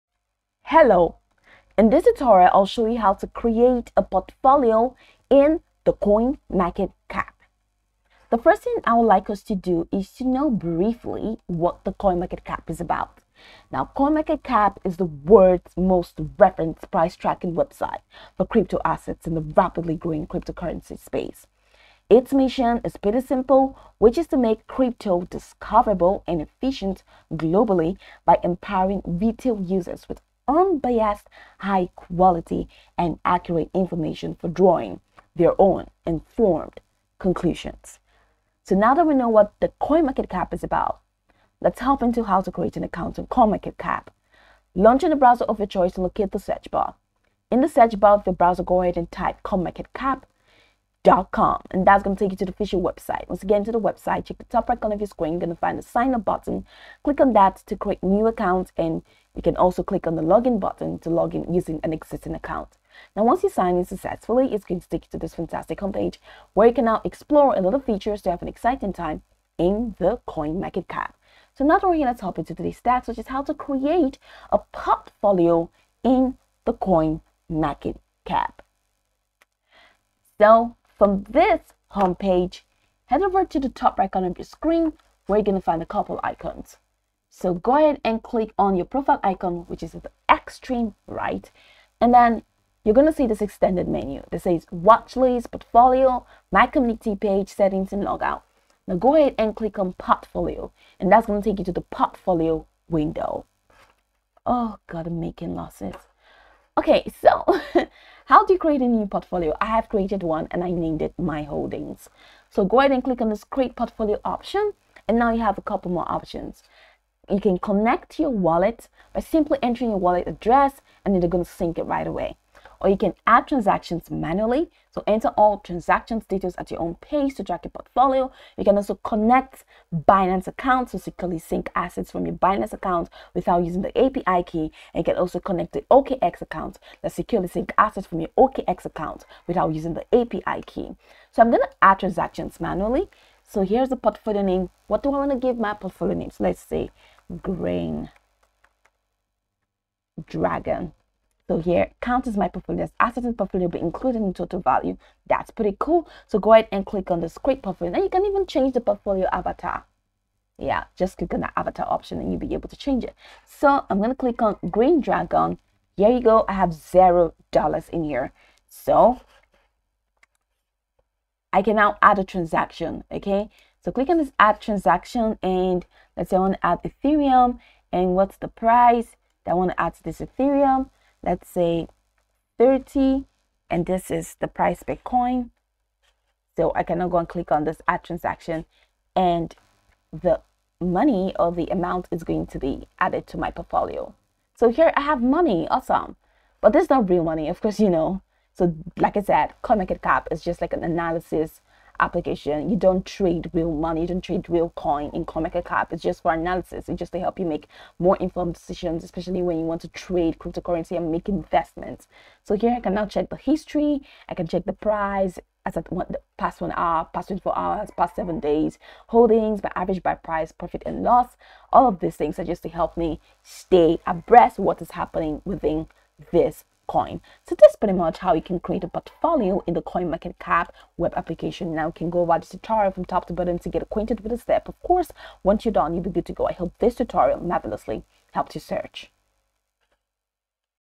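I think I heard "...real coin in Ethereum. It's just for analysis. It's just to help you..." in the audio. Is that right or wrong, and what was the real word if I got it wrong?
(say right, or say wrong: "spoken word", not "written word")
wrong: "CoinMarketCap", not "Ethereum".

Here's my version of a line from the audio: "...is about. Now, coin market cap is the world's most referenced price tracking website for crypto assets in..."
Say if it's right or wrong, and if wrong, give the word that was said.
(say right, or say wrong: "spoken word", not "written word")
right.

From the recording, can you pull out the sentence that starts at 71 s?
So now we're going to hop into today's stats, which is how to create a portfolio in the coin market cap.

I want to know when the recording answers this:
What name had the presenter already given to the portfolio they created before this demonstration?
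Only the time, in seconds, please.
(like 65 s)
111 s.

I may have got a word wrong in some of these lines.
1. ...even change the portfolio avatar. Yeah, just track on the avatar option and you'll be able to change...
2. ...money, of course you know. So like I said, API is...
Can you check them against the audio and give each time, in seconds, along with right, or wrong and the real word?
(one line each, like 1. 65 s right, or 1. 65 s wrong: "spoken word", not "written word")
1. 158 s wrong: "click", not "track"
2. 197 s wrong: "CoinMarketCap", not "API".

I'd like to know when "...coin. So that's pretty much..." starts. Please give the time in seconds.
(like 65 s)
226 s.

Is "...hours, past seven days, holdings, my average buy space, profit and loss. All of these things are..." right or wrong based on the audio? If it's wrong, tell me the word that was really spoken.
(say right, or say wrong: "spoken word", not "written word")
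wrong: "price", not "space".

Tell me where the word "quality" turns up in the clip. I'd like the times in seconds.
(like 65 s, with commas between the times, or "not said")
31 s.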